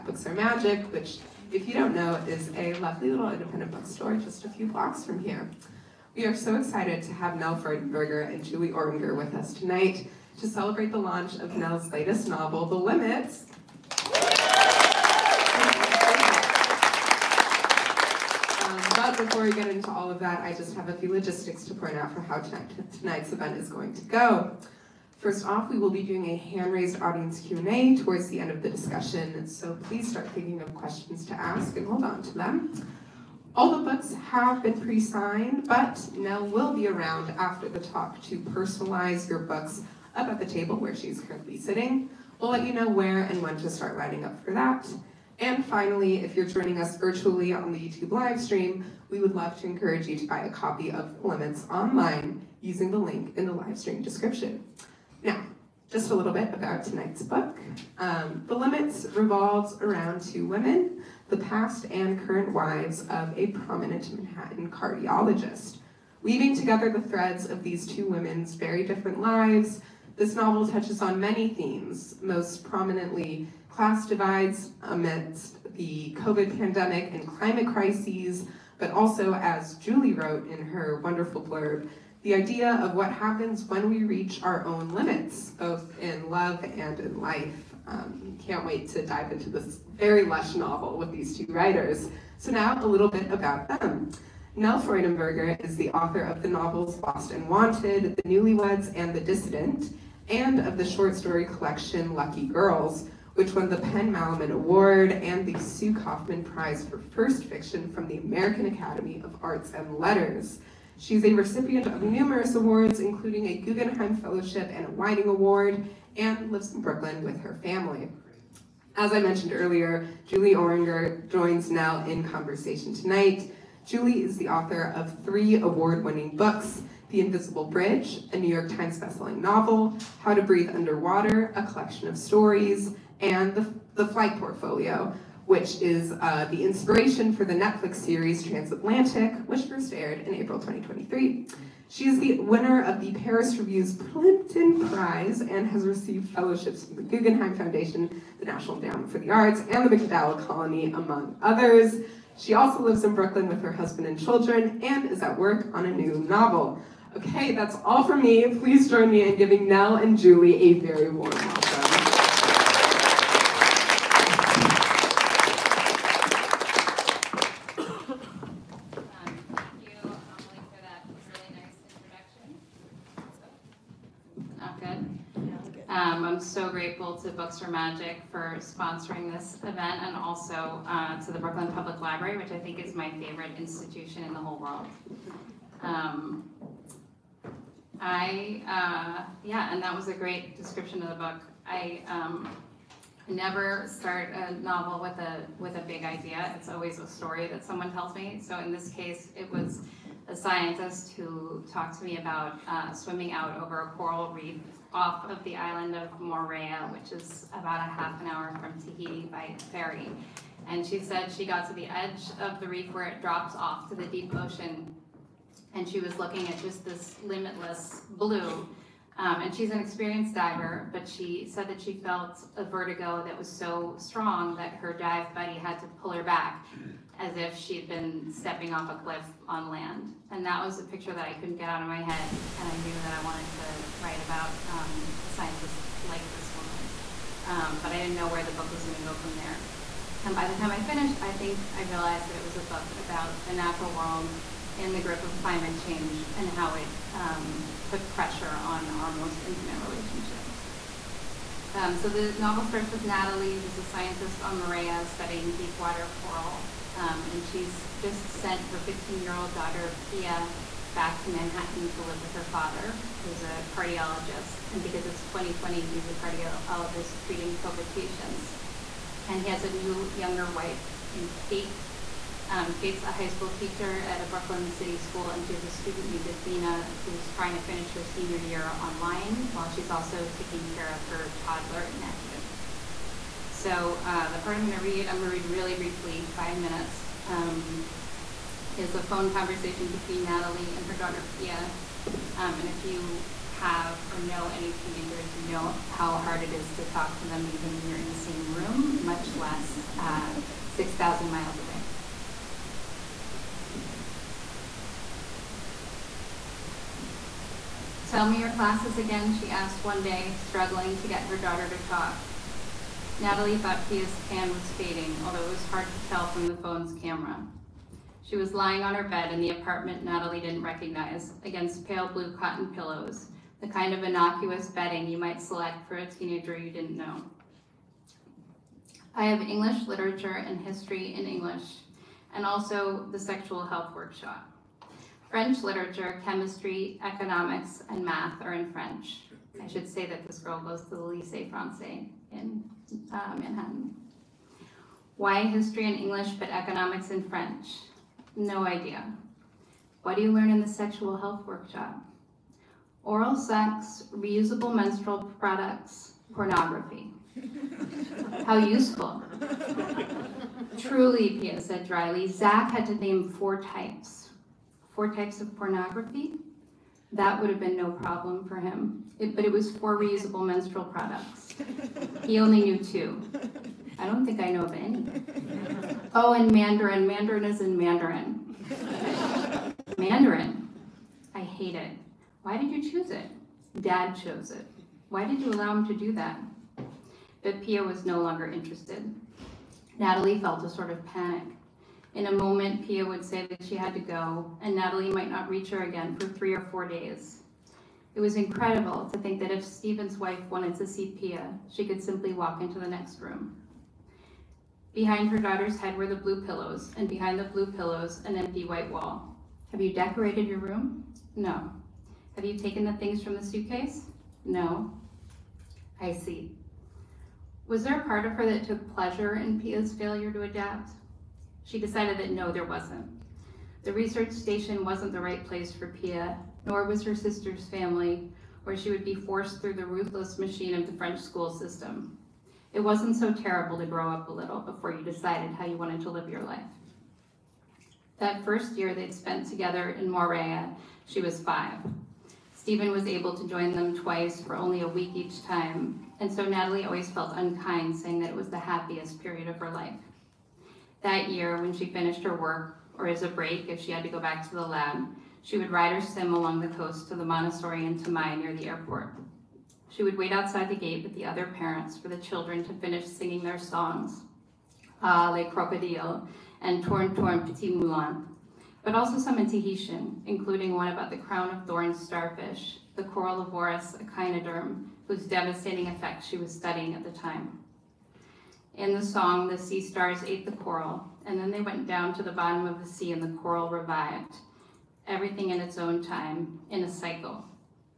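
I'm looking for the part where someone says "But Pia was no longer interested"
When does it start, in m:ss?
6:27.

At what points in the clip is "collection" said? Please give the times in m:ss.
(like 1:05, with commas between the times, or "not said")
1:41, 2:11.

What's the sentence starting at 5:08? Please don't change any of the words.
Tell me your classes again, she asked one day, struggling to get her daughter to talk.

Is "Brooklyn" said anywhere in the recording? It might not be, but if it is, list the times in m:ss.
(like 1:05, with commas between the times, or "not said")
1:56, 2:33, 3:01, 4:34.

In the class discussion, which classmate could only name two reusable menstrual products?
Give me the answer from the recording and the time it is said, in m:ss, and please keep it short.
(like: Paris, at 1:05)
Zach, at 6:02.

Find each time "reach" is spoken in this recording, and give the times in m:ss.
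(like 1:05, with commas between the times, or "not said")
1:24, 6:35.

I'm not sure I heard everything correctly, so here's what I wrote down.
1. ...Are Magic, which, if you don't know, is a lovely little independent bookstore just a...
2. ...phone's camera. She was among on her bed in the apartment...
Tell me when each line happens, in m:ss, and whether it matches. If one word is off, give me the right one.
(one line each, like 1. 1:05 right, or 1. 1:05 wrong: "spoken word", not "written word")
1. 0:00 right
2. 5:16 wrong: "lying", not "among".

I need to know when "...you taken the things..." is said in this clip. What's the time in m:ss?
6:52.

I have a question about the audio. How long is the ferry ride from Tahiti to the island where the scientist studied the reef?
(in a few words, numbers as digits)
half an hour.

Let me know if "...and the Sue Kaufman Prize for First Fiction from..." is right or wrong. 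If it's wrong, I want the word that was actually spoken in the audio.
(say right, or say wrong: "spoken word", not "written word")
right.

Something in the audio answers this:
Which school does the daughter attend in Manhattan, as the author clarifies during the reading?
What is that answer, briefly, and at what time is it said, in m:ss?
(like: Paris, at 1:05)
Lycée Francais, at 5:40.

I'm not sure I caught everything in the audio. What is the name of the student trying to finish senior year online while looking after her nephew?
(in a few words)
Athena.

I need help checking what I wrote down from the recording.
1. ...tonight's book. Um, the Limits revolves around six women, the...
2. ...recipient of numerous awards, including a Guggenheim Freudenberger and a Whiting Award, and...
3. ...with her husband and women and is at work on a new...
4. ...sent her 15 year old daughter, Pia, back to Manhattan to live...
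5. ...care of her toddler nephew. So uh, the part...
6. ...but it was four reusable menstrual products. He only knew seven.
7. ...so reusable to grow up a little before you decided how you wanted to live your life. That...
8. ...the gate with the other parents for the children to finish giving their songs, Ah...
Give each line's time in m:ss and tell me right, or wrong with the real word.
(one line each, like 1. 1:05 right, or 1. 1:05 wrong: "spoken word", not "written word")
1. 0:56 wrong: "two", not "six"
2. 1:51 wrong: "Fellowship", not "Freudenberger"
3. 2:33 wrong: "children", not "women"
4. 4:18 right
5. 4:40 right
6. 6:09 wrong: "two", not "seven"
7. 7:13 wrong: "terrible", not "reusable"
8. 7:40 wrong: "singing", not "giving".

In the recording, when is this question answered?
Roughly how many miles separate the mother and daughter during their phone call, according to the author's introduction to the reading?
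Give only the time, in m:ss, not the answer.
5:00.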